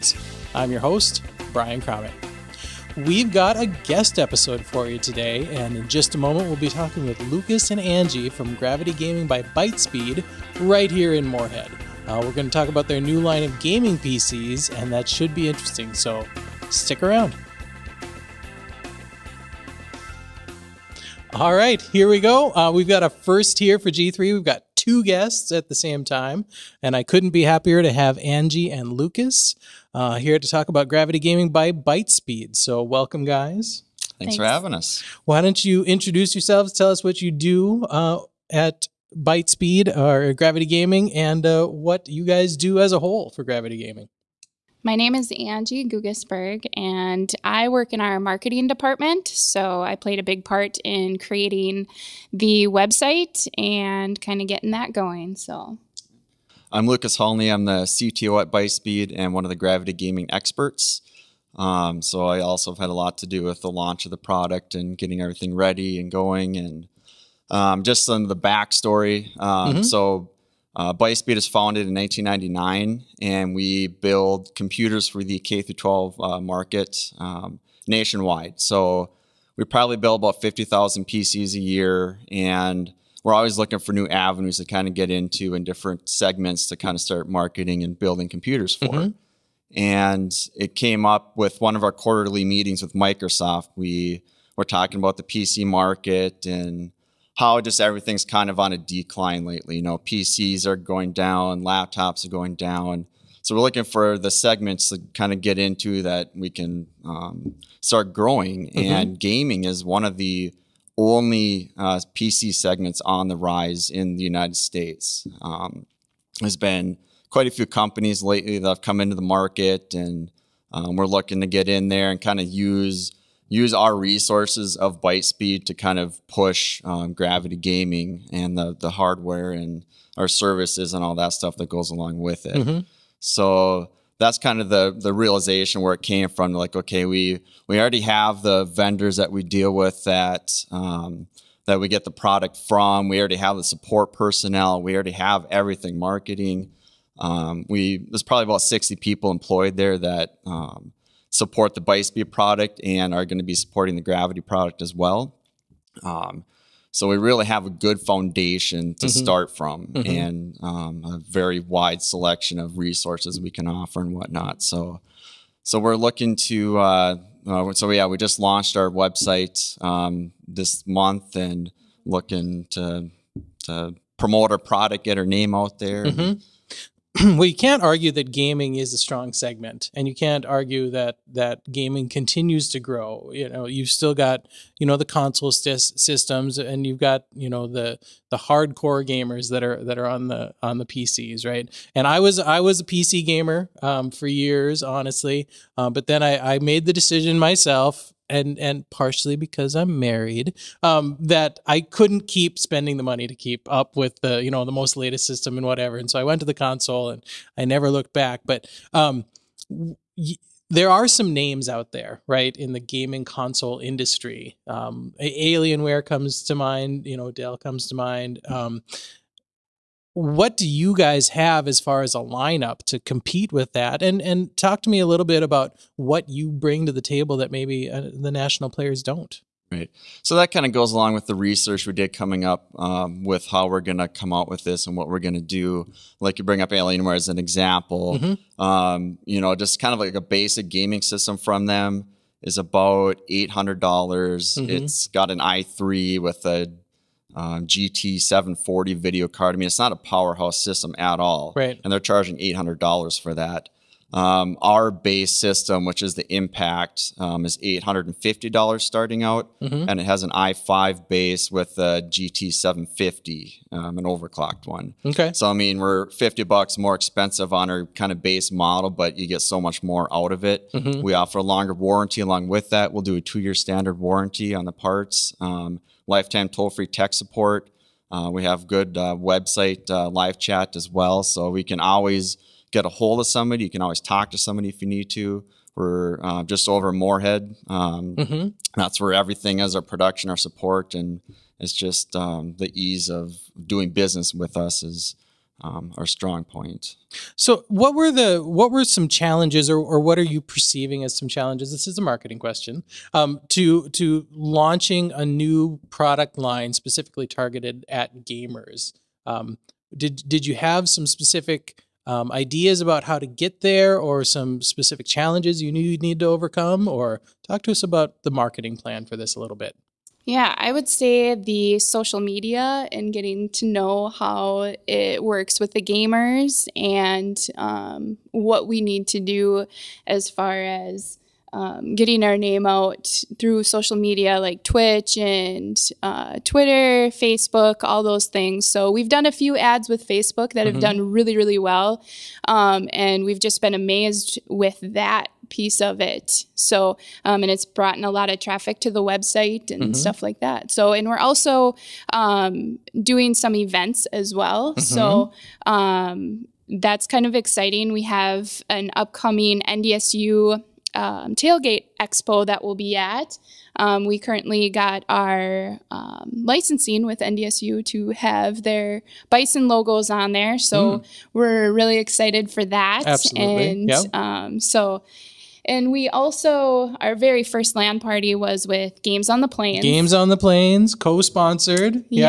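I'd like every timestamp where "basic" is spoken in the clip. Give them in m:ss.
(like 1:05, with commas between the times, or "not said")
4:00.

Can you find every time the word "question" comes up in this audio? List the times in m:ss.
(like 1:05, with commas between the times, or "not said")
5:02.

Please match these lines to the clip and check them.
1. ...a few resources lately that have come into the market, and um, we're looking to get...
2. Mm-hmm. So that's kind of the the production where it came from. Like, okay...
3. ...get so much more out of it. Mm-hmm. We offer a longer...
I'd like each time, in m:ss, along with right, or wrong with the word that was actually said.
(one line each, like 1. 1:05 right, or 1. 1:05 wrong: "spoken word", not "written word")
1. 1:57 wrong: "companies", not "resources"
2. 2:12 wrong: "realization", not "production"
3. 4:29 right.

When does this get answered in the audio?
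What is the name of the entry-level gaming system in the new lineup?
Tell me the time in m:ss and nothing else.
4:16.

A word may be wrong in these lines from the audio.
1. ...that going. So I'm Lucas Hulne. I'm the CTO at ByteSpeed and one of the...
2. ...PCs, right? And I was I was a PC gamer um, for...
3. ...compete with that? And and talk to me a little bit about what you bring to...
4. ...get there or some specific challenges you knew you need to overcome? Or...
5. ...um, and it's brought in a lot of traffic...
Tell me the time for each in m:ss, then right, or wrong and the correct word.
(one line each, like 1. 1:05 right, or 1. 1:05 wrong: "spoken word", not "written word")
1. 0:54 right
2. 3:10 right
3. 3:42 right
4. 5:13 right
5. 5:47 right.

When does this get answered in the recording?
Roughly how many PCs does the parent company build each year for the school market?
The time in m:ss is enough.
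1:20.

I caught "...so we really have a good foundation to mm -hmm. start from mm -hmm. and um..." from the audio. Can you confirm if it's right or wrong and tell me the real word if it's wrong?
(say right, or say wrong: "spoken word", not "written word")
right.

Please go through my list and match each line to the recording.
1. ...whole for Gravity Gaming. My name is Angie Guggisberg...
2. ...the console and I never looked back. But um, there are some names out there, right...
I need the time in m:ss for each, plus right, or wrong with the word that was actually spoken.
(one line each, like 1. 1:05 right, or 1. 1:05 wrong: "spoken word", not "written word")
1. 0:42 right
2. 3:26 right.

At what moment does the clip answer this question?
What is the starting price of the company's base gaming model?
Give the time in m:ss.
4:17.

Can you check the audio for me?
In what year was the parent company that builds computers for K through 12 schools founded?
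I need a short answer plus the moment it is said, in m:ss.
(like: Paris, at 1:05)
1999, at 1:11.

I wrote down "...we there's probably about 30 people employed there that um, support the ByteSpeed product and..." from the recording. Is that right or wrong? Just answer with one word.
wrong.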